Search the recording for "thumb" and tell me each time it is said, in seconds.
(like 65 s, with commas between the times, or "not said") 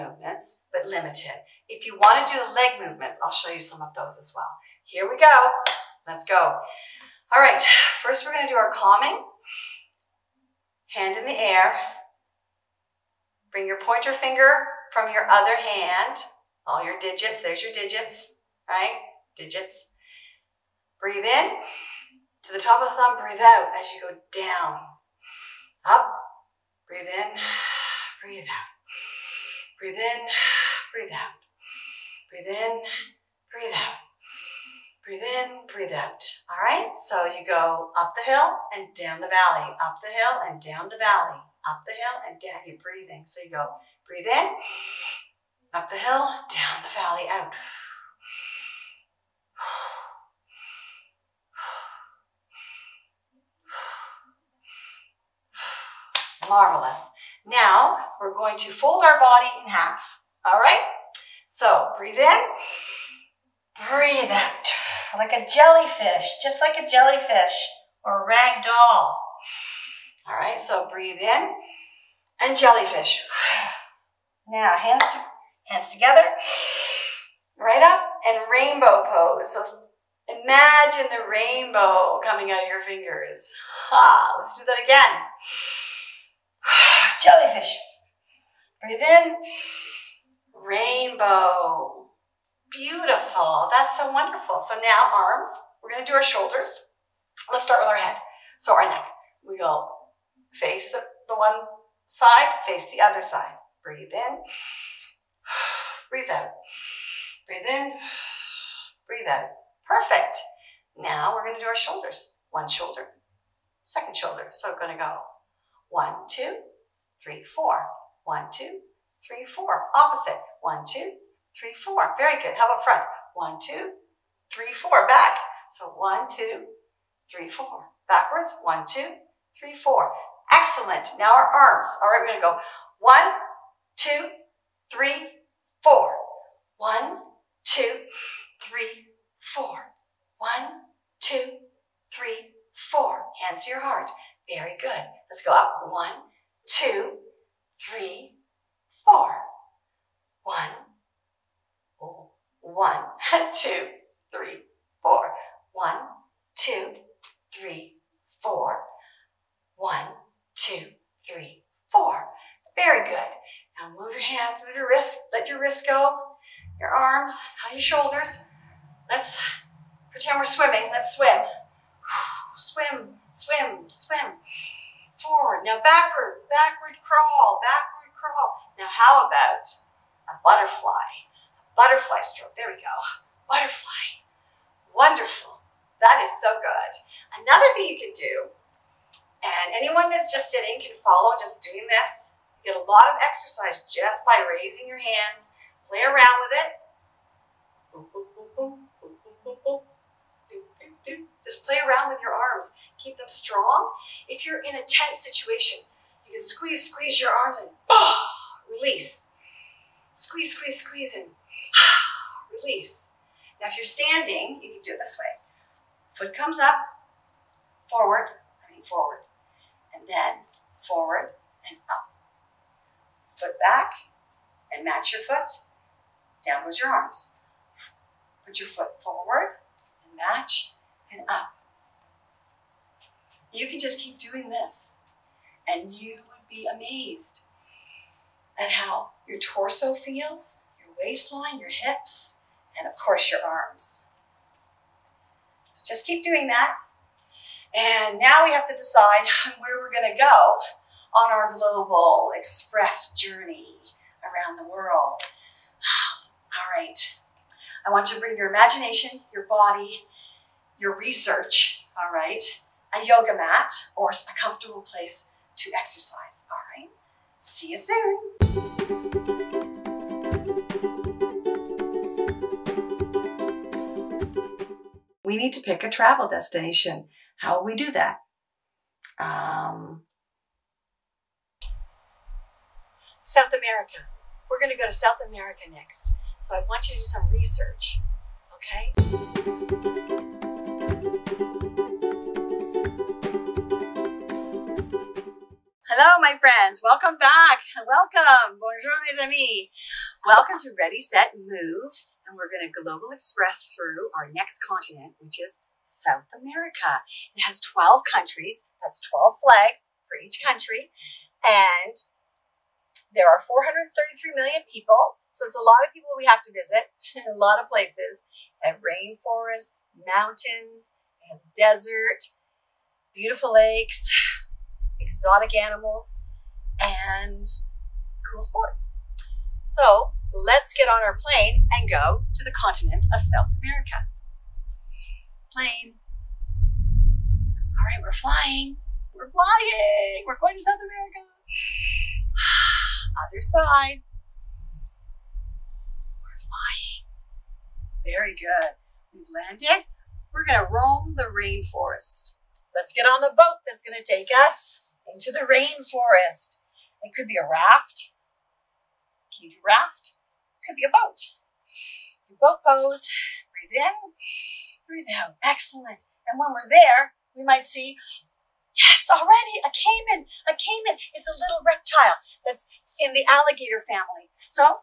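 22 s.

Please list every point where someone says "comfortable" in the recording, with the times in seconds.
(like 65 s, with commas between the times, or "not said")
264 s.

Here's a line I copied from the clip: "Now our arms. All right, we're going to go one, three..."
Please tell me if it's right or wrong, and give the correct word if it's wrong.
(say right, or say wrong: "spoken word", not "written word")
wrong: "two", not "three".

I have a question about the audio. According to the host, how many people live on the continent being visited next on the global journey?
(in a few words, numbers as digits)
433 million.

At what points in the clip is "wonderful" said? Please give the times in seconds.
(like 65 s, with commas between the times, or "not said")
94 s, 184 s.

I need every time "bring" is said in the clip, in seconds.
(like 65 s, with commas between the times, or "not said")
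13 s, 258 s.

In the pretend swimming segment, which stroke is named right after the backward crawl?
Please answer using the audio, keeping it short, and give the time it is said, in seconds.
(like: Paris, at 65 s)
Butterfly stroke, at 181 s.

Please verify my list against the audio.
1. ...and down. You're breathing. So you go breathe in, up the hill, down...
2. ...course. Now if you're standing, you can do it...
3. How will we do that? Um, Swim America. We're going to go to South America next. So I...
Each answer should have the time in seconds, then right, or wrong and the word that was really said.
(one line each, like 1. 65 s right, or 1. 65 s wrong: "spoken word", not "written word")
1. 42 s right
2. 212 s wrong: "release", not "course"
3. 277 s wrong: "South", not "Swim".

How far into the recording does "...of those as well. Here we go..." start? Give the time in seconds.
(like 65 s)
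3 s.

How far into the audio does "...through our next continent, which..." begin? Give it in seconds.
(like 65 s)
303 s.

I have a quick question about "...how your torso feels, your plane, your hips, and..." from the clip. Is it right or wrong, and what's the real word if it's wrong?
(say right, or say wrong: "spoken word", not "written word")
wrong: "waistline", not "plane".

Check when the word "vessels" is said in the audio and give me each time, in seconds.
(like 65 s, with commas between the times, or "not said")
not said.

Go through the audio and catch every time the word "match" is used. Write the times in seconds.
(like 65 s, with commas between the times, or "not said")
224 s, 230 s.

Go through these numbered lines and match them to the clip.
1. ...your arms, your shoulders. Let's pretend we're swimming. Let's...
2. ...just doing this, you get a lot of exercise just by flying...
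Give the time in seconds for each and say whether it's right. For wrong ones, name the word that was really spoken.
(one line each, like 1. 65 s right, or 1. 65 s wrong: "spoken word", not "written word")
1. 166 s right
2. 191 s wrong: "raising", not "flying".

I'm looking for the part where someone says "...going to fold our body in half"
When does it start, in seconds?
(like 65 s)
58 s.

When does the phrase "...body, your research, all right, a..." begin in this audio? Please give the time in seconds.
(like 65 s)
259 s.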